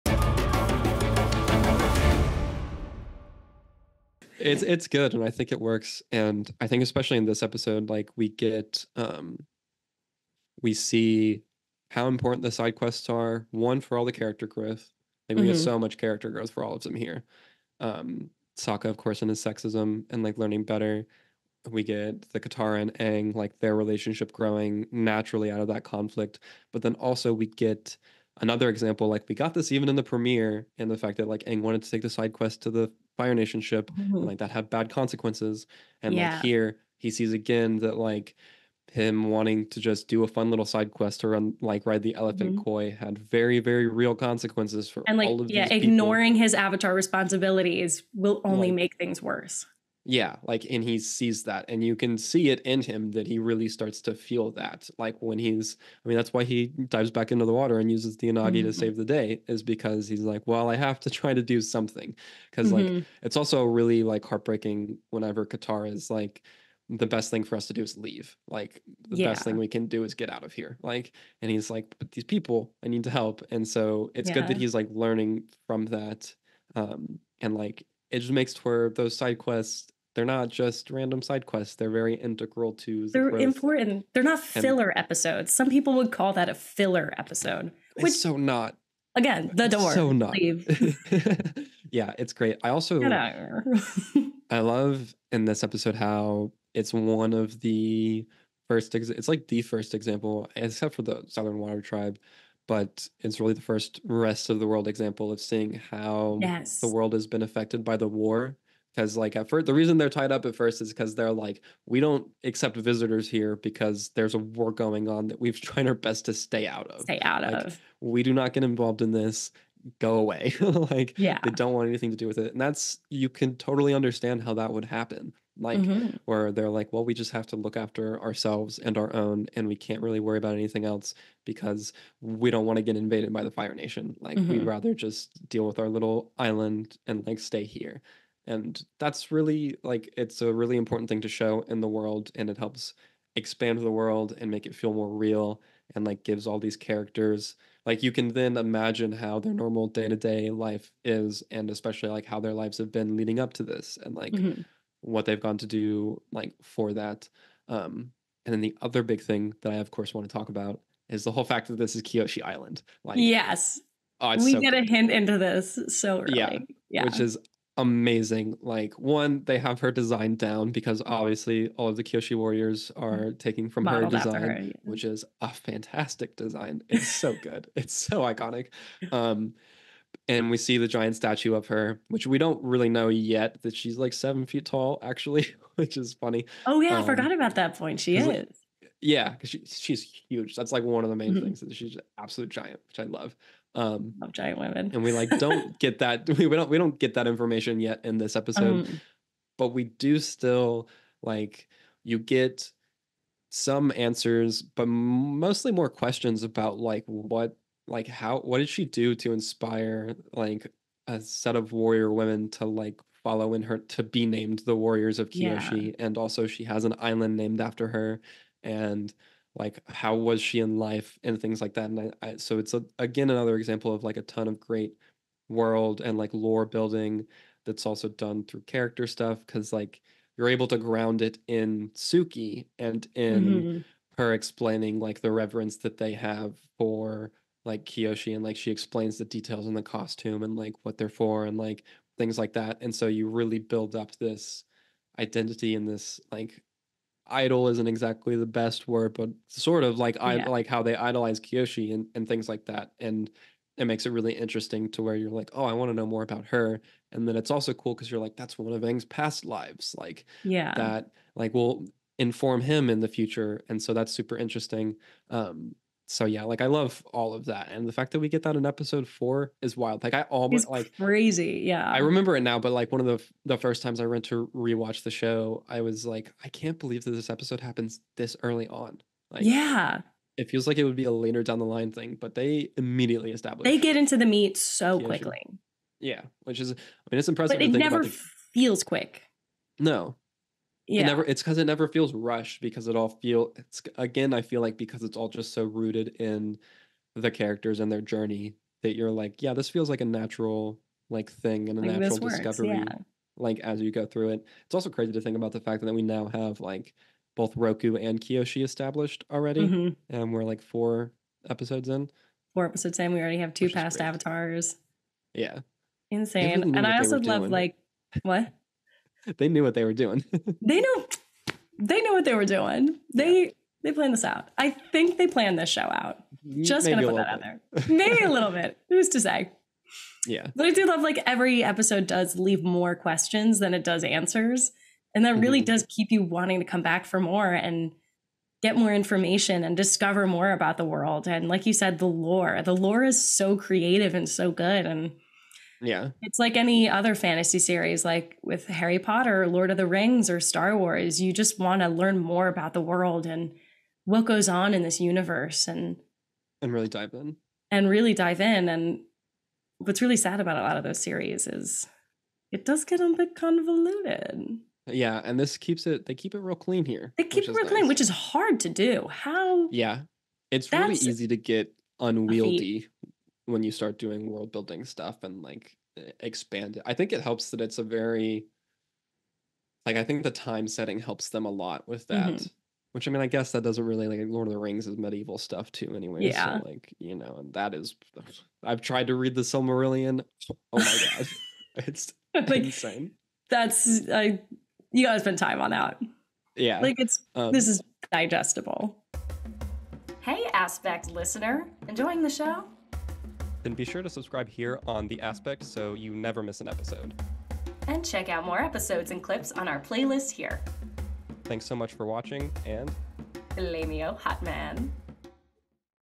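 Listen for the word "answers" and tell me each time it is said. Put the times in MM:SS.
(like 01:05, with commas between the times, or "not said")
03:23, 05:34.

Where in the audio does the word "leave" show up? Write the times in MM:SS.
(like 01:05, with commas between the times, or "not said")
01:07, 05:32.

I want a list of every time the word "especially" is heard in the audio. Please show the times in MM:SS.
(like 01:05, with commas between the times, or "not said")
00:06, 02:31.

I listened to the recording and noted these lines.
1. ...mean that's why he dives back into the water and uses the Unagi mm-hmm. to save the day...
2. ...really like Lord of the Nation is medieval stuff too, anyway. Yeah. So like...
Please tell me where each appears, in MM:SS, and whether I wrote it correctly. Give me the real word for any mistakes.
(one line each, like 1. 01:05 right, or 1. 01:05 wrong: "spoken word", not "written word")
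1. 00:56 right
2. 06:23 wrong: "Rings", not "Nation".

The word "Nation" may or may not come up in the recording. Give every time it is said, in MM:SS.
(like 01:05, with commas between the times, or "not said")
00:33, 02:13.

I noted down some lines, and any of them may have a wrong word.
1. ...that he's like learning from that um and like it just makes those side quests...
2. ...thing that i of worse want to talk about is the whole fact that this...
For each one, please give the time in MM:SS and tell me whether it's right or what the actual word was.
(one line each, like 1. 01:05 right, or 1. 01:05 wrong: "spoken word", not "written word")
1. 01:14 right
2. 02:39 wrong: "course", not "worse".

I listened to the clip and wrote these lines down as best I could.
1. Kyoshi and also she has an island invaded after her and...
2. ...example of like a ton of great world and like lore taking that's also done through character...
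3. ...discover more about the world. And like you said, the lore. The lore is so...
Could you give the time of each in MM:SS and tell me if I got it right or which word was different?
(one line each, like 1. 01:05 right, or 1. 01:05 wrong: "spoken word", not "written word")
1. 03:35 wrong: "named", not "invaded"
2. 03:43 wrong: "building", not "taking"
3. 05:39 right.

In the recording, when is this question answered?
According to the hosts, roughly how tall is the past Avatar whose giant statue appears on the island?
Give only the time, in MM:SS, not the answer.
03:04.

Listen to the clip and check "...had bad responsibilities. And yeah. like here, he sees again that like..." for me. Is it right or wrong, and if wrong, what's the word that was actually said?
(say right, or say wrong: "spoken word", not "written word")
wrong: "consequences", not "responsibilities".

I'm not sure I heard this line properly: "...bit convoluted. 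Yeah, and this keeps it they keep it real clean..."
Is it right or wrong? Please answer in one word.
right.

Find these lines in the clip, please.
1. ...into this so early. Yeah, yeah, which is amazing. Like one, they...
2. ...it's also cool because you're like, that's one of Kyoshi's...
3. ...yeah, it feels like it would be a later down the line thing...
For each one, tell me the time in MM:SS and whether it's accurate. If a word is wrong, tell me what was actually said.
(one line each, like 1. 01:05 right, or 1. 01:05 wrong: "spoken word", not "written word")
1. 02:45 right
2. 04:17 wrong: "Aang", not "Kyoshi"
3. 04:39 right.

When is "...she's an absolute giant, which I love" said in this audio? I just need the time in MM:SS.
03:11.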